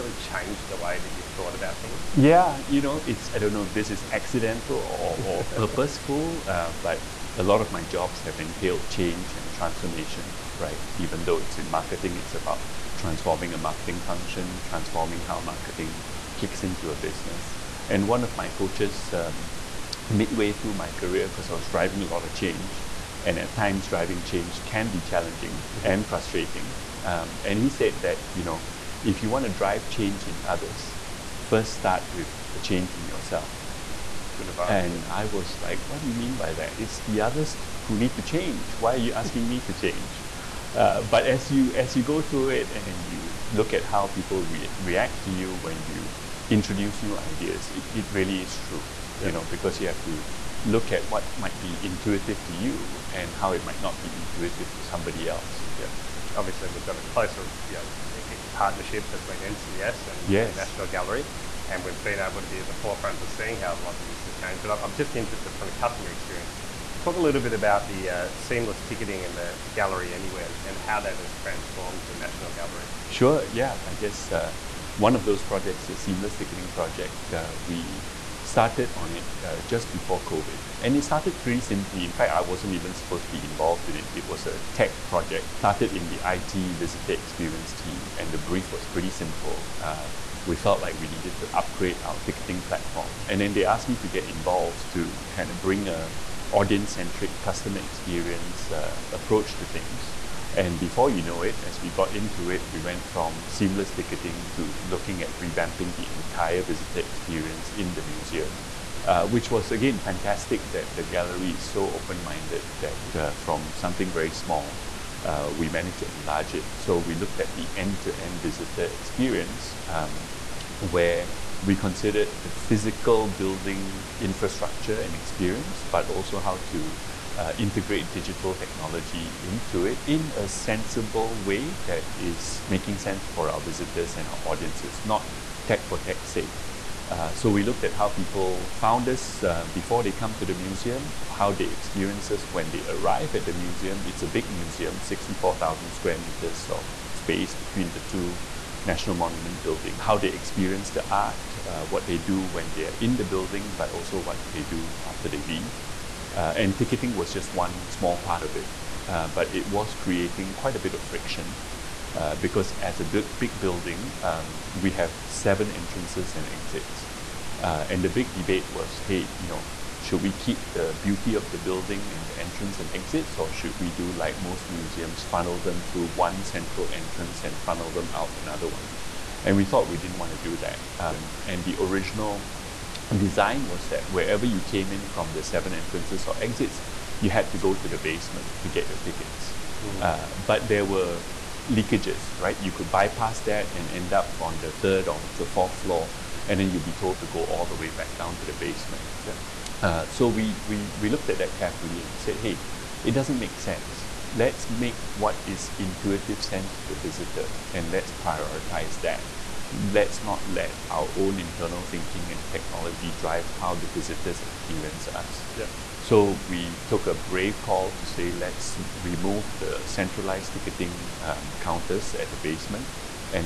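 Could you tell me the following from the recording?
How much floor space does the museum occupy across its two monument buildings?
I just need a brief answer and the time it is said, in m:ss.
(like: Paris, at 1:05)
64,000 square meters, at 2:25.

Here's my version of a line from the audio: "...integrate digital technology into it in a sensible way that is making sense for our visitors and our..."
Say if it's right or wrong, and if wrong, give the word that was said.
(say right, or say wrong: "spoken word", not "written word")
right.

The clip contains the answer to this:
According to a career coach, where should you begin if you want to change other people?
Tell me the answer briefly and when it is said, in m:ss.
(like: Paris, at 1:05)
A change in yourself, at 0:32.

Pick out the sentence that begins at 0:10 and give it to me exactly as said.
Even though it's in marketing, it's about transforming a marketing function, transforming how marketing clicks into a business.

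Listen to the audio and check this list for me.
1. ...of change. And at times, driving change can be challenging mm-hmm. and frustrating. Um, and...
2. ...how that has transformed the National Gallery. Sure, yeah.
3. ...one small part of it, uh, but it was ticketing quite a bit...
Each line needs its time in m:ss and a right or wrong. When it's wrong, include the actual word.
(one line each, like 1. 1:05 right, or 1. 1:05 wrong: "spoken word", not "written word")
1. 0:22 right
2. 1:10 right
3. 2:37 wrong: "creating", not "ticketing".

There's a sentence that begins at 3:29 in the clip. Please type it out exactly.
Let's not let our own internal thinking and technology drive how the visitors experience us.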